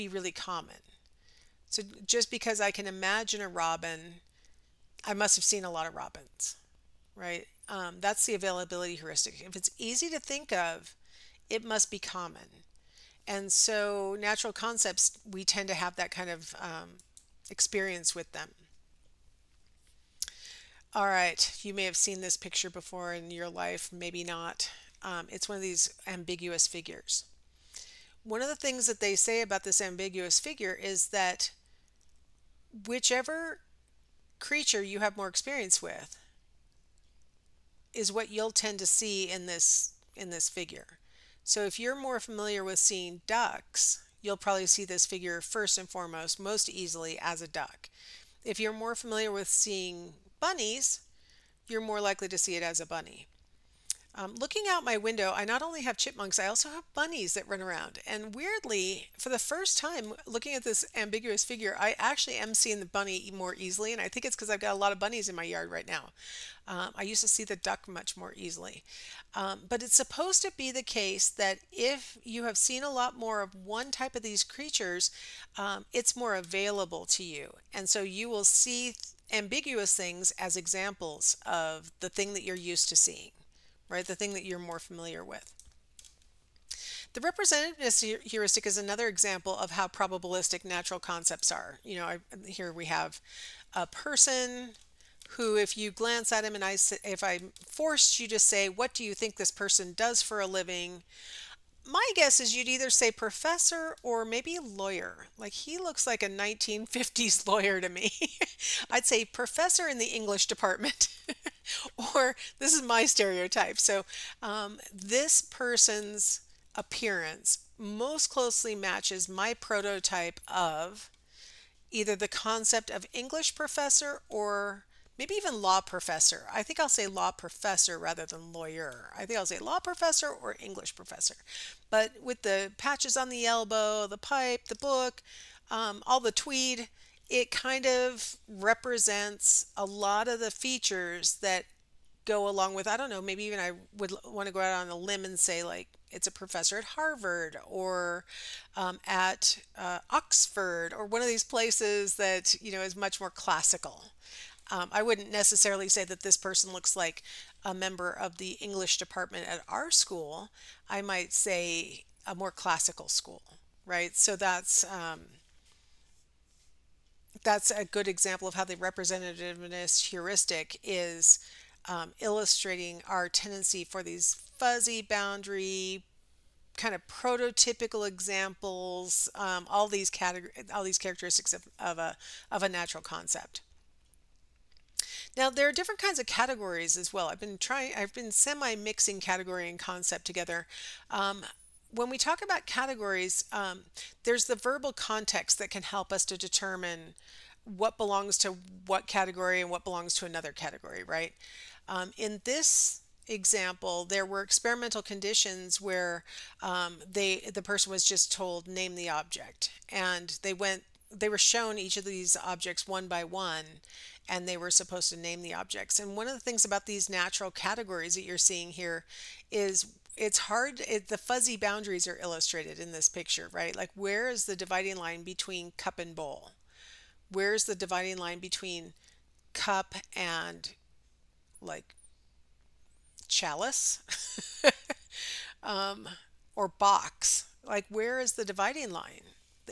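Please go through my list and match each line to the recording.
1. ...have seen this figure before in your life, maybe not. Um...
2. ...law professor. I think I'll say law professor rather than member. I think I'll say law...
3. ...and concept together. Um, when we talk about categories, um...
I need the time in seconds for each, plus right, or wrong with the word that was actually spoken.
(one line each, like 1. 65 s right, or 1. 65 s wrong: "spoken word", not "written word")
1. 21 s wrong: "picture", not "figure"
2. 125 s wrong: "lawyer", not "member"
3. 189 s right.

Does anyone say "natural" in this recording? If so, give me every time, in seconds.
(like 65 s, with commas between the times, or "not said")
14 s, 90 s, 182 s, 217 s.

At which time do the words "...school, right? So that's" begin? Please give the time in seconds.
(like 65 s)
163 s.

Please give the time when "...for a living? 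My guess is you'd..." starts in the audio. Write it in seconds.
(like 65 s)
100 s.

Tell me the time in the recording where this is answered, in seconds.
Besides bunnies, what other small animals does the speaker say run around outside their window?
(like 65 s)
55 s.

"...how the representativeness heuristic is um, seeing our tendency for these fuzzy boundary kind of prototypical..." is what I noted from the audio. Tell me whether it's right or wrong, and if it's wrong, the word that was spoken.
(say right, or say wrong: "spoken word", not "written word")
wrong: "illustrating", not "seeing".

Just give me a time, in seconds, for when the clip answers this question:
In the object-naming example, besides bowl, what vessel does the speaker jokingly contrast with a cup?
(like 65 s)
233 s.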